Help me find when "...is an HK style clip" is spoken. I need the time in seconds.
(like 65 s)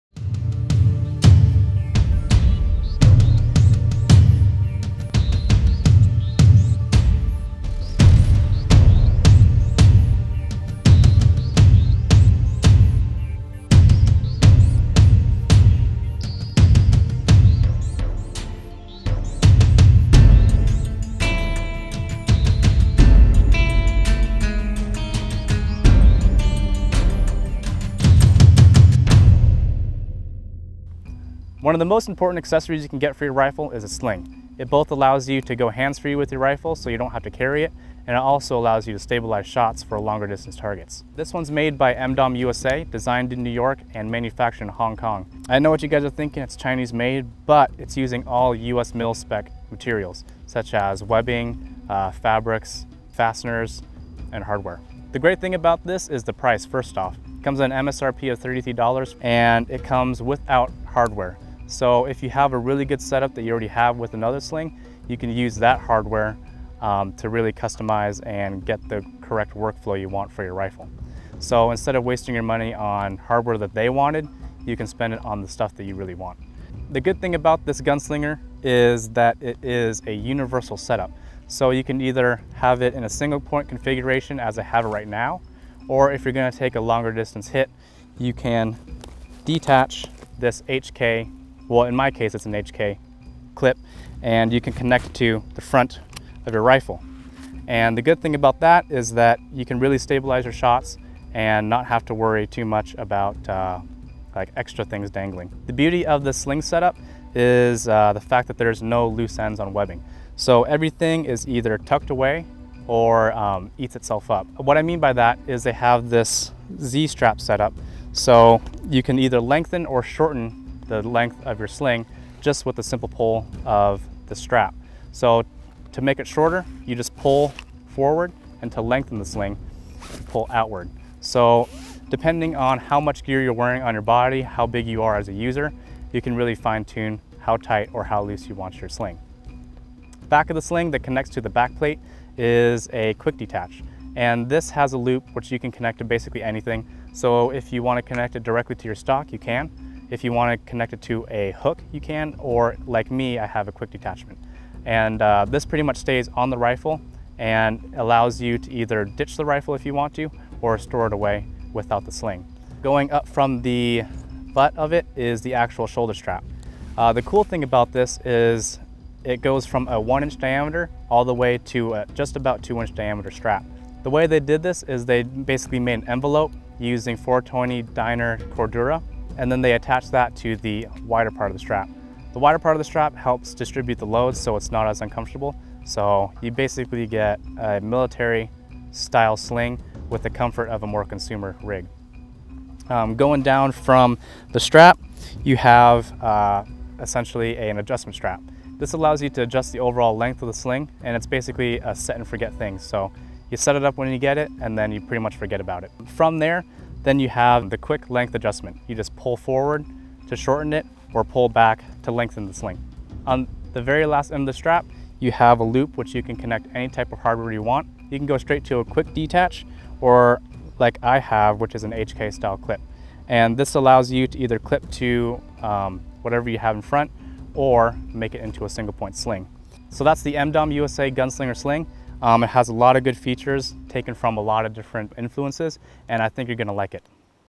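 221 s.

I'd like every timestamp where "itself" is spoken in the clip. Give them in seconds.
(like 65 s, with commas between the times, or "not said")
113 s.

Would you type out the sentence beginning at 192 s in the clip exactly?
Um, going down from the strap, you have uh, essentially an adjustment strap.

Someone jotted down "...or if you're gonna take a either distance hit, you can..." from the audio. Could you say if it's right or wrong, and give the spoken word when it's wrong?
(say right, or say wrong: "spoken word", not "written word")
wrong: "longer", not "either".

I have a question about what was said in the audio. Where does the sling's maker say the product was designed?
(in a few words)
New York.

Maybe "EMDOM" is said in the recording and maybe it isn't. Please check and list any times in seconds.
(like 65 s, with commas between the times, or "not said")
41 s, 230 s.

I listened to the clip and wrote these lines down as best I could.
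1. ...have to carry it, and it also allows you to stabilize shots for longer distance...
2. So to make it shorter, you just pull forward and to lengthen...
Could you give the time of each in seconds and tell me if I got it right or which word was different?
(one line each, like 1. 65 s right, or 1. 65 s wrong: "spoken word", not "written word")
1. 37 s right
2. 125 s right.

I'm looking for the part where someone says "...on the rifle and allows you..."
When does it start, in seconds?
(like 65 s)
156 s.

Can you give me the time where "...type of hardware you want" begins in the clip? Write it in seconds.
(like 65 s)
216 s.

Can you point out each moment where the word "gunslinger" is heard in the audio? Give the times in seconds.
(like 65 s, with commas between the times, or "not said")
77 s, 231 s.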